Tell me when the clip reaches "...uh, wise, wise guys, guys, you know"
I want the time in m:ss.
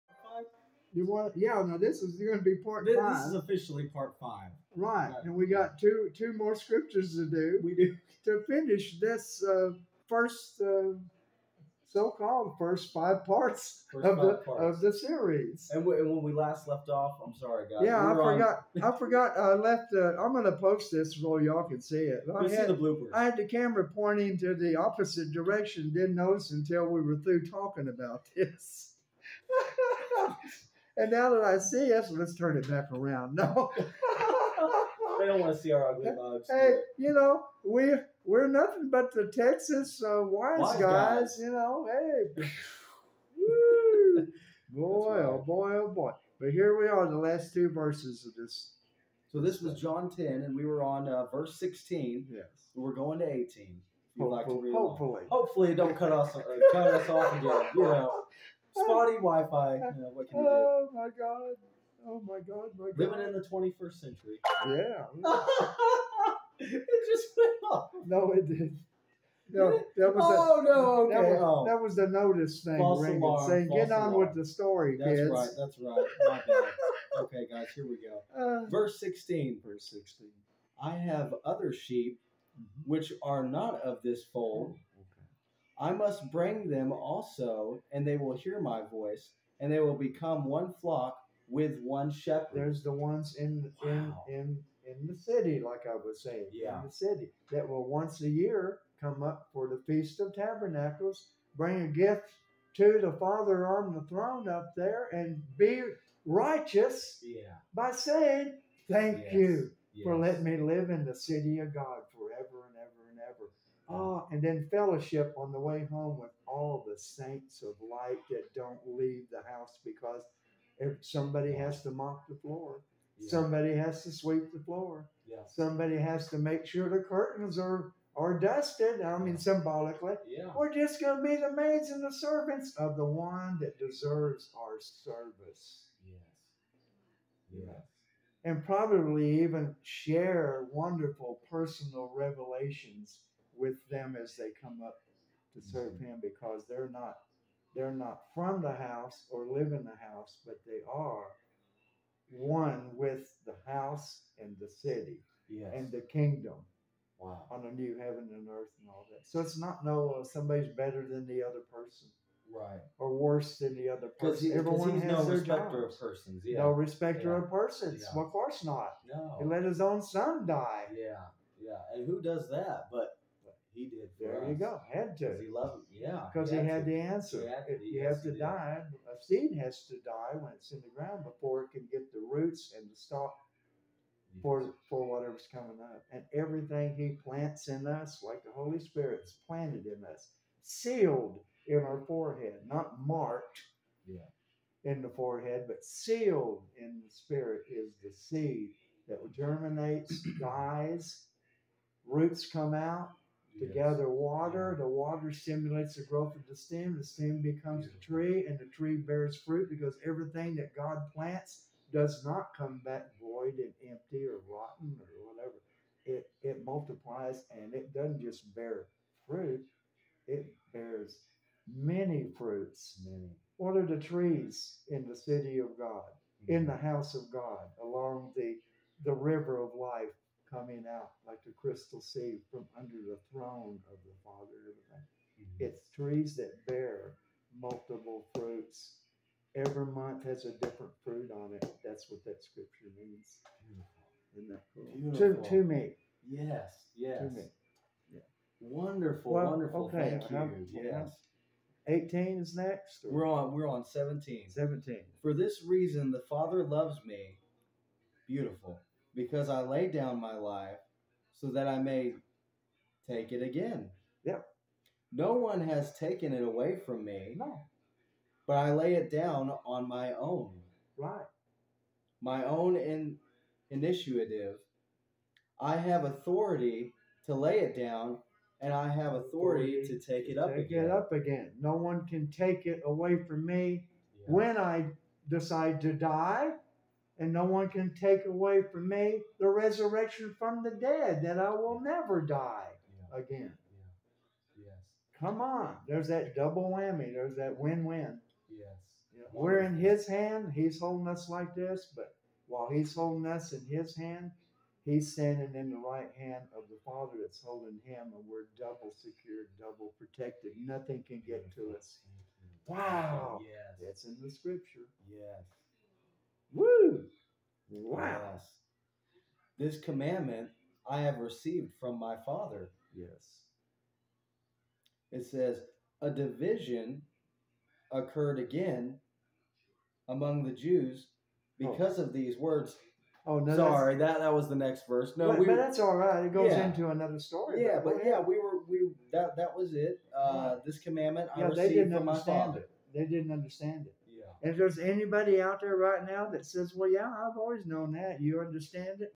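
0:40.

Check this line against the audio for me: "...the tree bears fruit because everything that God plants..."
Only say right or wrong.
right.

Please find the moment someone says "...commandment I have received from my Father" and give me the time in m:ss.
5:19.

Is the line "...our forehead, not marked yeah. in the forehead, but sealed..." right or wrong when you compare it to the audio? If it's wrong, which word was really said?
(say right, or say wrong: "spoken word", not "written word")
right.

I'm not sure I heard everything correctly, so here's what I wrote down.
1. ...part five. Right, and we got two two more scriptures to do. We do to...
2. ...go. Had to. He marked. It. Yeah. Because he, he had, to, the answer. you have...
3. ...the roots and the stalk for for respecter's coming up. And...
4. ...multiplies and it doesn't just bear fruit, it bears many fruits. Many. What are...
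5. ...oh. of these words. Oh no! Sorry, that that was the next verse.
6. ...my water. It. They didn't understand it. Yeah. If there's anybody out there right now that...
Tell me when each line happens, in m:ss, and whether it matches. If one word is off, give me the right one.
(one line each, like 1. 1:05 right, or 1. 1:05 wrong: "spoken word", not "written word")
1. 0:03 right
2. 2:54 wrong: "loved", not "marked"
3. 3:02 wrong: "whatever", not "respecter"
4. 3:36 right
5. 5:31 right
6. 5:42 wrong: "father", not "water".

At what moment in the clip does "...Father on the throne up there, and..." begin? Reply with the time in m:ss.
1:43.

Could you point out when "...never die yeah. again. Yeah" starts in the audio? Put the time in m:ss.
4:51.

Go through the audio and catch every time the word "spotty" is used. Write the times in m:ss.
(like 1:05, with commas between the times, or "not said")
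0:58.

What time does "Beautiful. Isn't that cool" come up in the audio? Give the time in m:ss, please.
4:03.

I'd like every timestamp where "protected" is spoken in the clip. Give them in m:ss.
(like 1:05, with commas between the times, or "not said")
5:09.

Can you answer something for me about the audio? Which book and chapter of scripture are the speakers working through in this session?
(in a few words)
John 10.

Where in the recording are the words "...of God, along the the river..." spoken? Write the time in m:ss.
3:47.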